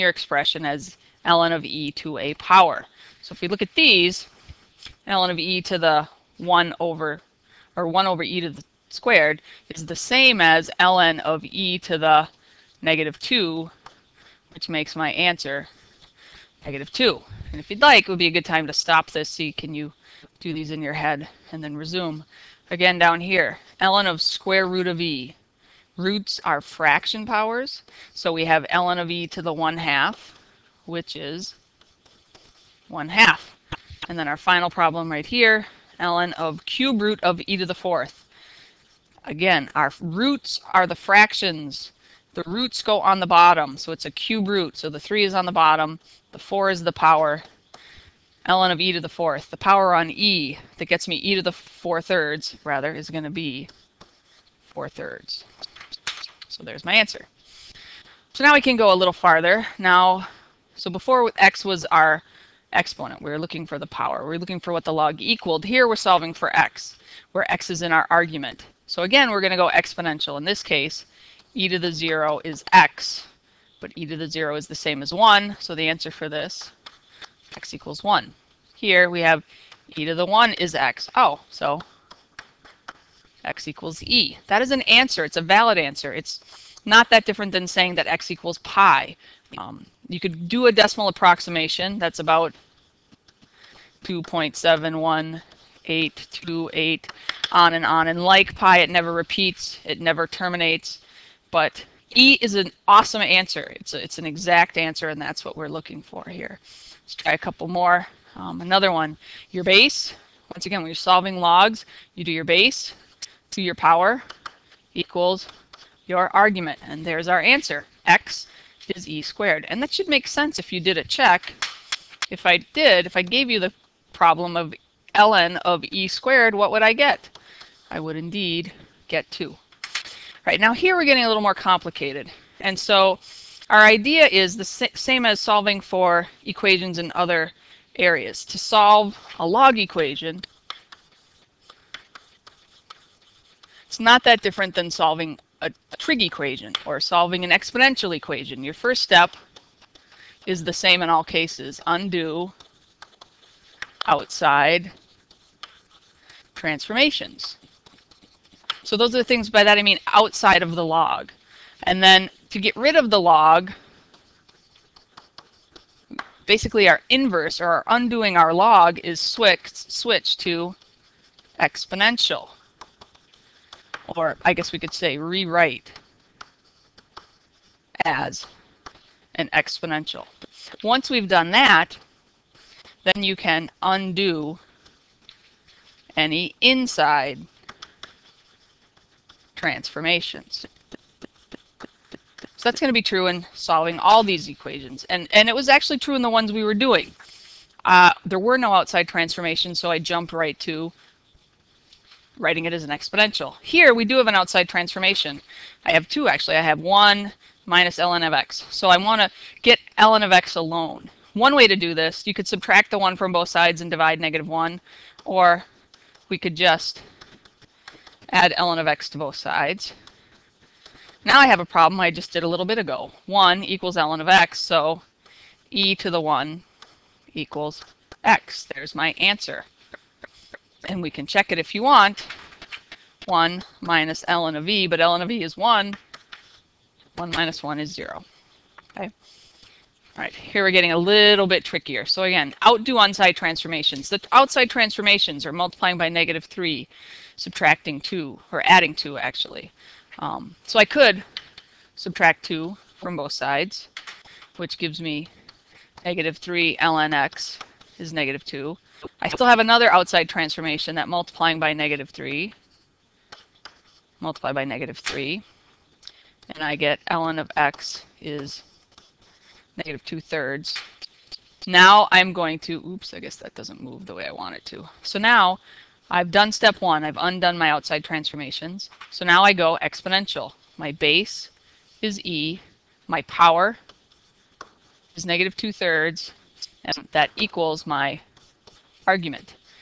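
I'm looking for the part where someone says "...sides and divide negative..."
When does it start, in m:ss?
3:33.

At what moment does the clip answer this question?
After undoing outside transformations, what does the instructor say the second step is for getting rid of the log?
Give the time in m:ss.
2:55.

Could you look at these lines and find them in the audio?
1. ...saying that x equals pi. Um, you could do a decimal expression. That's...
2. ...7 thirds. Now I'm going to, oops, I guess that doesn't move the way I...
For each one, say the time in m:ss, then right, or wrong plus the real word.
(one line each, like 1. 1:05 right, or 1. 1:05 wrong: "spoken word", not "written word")
1. 1:27 wrong: "approximation", not "expression"
2. 4:30 wrong: "2", not "7".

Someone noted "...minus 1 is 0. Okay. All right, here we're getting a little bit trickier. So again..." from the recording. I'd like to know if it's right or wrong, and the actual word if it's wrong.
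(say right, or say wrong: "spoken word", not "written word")
right.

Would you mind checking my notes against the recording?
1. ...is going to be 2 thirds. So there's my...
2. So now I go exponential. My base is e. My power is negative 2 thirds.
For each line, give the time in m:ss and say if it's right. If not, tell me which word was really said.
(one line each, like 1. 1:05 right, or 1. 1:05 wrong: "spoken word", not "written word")
1. 0:52 wrong: "4", not "2"
2. 4:39 right.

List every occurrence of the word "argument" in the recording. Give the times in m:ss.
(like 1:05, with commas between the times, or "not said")
1:08, 1:56, 4:49.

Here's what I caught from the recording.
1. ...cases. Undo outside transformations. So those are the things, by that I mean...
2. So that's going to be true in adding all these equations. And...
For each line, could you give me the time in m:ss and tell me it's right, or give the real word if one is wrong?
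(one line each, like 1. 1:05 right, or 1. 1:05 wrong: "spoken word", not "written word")
1. 2:31 right
2. 3:12 wrong: "solving", not "adding".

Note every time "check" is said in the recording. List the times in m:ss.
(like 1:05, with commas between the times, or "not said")
2:01, 3:51.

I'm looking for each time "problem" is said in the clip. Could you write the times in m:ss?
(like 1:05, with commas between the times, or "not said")
0:34, 2:04, 3:41.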